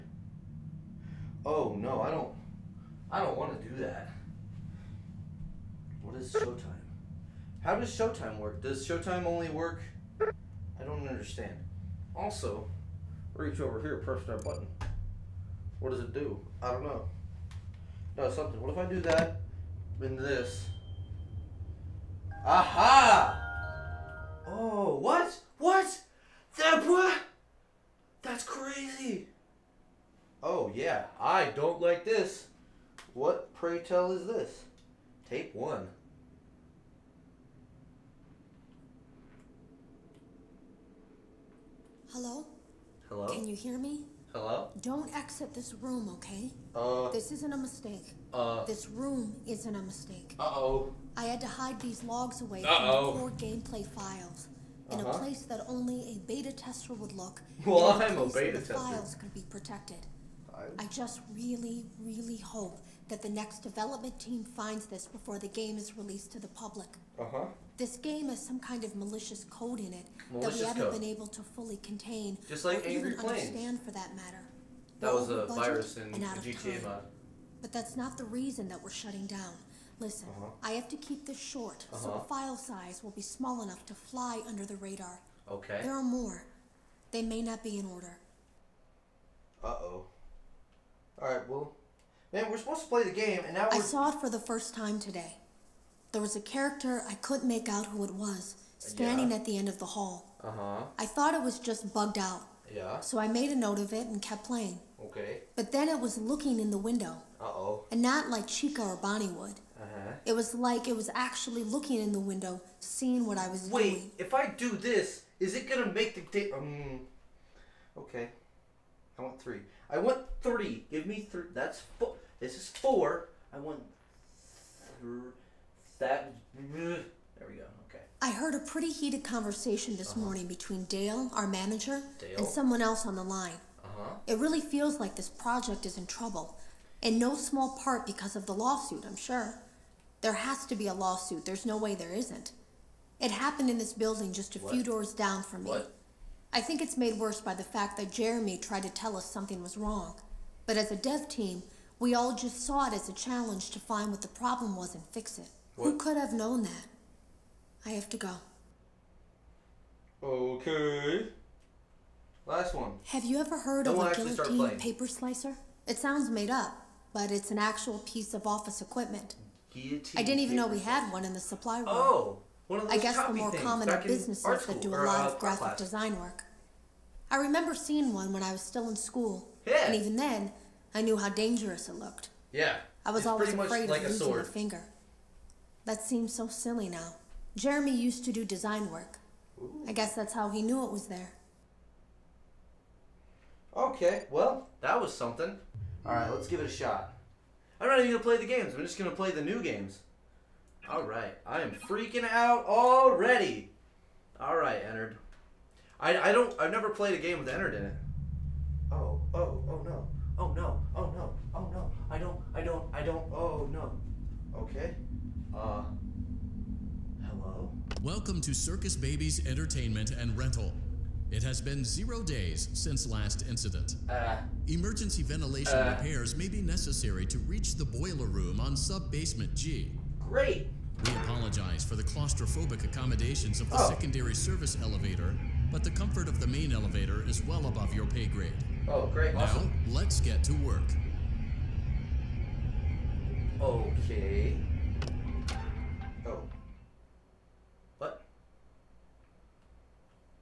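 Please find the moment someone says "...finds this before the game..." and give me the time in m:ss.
1:04.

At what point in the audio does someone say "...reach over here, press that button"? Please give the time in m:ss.
0:13.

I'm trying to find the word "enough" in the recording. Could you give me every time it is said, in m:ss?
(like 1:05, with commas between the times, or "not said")
1:23.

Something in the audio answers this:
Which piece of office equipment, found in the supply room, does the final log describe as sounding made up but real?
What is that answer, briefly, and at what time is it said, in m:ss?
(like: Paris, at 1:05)
Guillotine paper slicer, at 2:44.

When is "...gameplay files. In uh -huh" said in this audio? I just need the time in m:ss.
0:53.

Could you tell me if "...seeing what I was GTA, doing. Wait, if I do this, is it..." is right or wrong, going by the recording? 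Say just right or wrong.
wrong.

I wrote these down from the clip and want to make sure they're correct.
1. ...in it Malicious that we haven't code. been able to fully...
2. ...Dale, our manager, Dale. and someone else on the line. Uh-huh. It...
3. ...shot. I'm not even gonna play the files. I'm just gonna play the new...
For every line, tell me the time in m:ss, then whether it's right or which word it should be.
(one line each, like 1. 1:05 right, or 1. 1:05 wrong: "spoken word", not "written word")
1. 1:09 right
2. 2:10 right
3. 3:16 wrong: "games", not "files".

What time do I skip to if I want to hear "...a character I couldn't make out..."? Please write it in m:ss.
1:36.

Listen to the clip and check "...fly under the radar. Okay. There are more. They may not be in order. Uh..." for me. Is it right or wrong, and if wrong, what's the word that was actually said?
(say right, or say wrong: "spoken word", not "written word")
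right.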